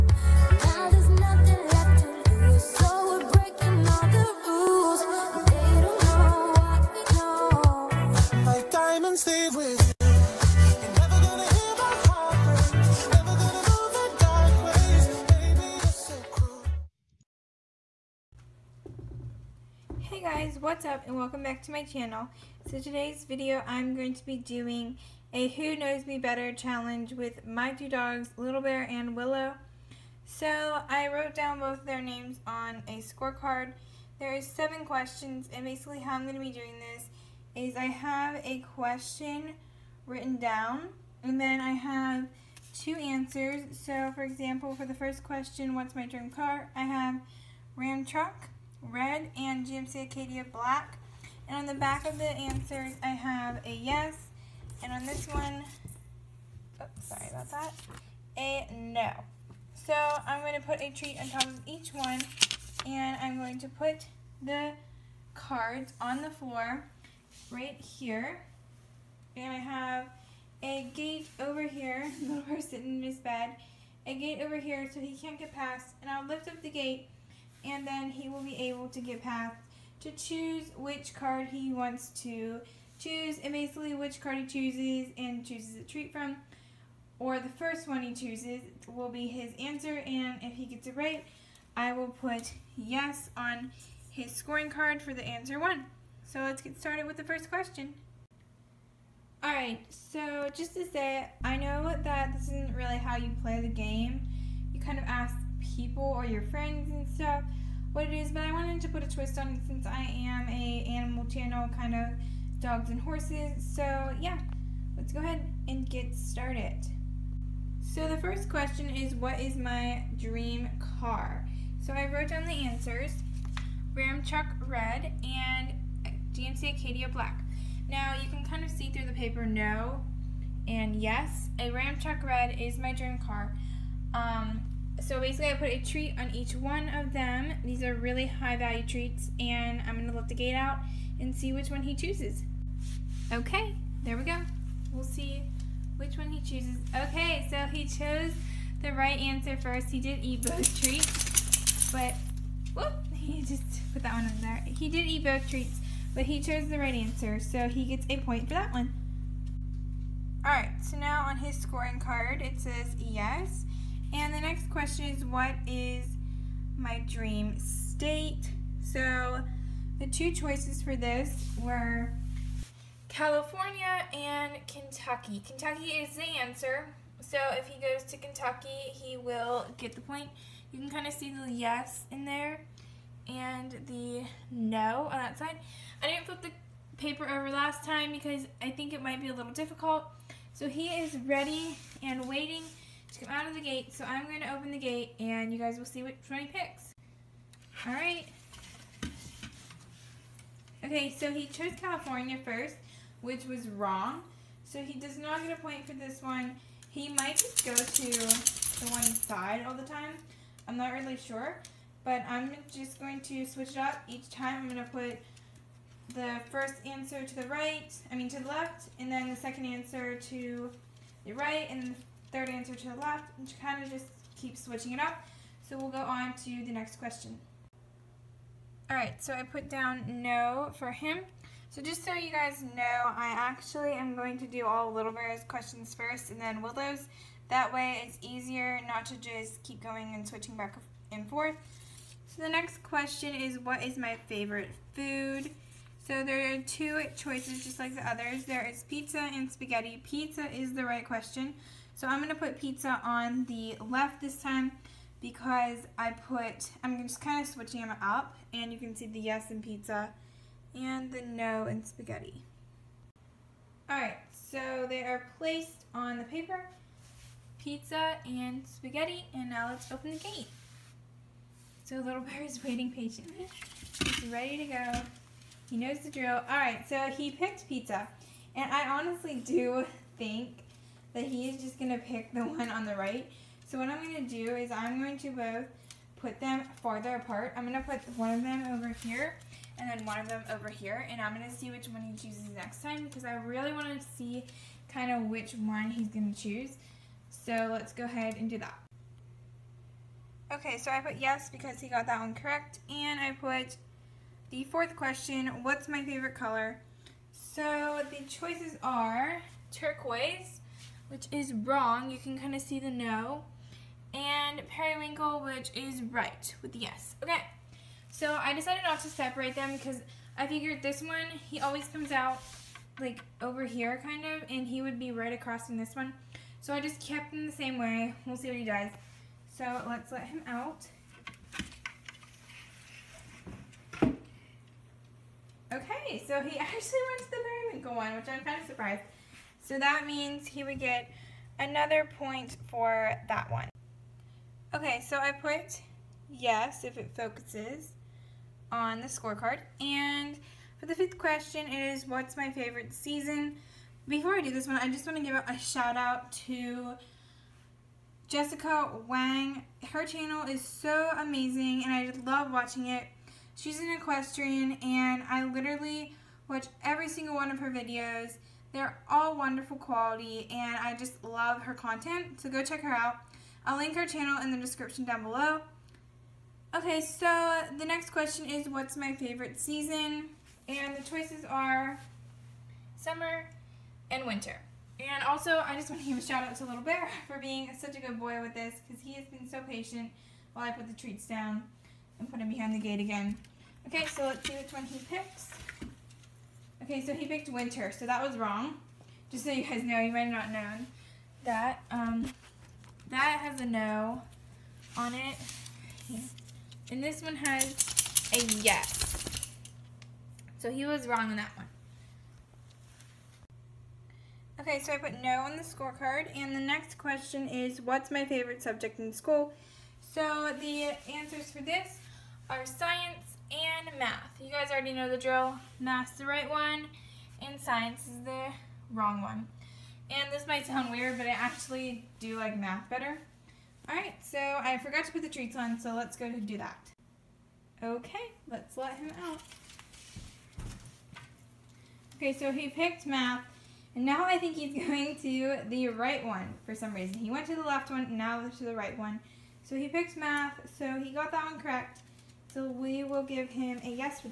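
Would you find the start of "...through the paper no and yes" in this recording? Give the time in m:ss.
2:08.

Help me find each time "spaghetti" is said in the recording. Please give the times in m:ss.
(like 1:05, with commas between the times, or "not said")
4:09, 4:21, 4:28.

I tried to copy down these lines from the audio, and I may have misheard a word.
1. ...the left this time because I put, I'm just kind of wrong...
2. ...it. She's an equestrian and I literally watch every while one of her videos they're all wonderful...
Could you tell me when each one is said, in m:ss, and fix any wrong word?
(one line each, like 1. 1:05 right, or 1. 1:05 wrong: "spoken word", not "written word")
1. 4:13 wrong: "switching", not "wrong"
2. 6:02 wrong: "single", not "while".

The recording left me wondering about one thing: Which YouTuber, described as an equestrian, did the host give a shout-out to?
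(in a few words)
Jessica Wang.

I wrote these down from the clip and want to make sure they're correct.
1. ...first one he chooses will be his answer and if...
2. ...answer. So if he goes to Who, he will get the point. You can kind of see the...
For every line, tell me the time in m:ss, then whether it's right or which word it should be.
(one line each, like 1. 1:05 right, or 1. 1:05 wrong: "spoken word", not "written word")
1. 1:27 right
2. 2:56 wrong: "Kentucky", not "Who".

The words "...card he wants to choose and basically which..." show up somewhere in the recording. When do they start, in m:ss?
1:21.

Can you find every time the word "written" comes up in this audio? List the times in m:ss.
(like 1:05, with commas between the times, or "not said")
0:40.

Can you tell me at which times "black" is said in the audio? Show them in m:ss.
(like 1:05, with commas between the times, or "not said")
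0:50, 2:07.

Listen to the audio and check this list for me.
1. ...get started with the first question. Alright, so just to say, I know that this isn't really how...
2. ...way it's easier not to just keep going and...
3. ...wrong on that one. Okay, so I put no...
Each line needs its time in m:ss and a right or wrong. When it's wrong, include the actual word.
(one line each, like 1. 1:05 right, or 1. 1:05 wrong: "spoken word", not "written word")
1. 1:36 right
2. 3:57 right
3. 6:51 right.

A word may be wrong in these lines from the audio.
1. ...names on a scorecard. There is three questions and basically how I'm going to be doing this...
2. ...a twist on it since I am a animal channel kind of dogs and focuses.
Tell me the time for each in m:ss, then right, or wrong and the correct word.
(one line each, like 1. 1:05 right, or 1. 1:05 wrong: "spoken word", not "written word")
1. 0:32 wrong: "seven", not "three"
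2. 1:49 wrong: "horses", not "focuses".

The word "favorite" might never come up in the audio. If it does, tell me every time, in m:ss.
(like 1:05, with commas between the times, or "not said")
4:04, 5:06, 5:52, 6:19, 6:58.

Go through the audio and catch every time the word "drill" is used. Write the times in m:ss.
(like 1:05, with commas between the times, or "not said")
4:36, 7:05.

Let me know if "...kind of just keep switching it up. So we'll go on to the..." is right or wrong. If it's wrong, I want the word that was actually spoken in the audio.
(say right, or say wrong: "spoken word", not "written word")
right.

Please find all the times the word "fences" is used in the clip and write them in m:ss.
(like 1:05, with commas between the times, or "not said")
not said.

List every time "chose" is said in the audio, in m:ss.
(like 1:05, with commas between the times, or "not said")
2:27, 2:36, 3:21.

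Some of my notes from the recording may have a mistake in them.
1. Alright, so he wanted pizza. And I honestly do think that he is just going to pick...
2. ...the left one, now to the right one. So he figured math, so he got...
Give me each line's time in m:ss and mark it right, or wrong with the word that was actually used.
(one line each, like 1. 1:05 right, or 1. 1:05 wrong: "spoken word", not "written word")
1. 4:36 wrong: "picked", not "wanted"
2. 7:27 wrong: "picked", not "figured".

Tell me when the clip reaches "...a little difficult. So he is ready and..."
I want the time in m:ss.
3:09.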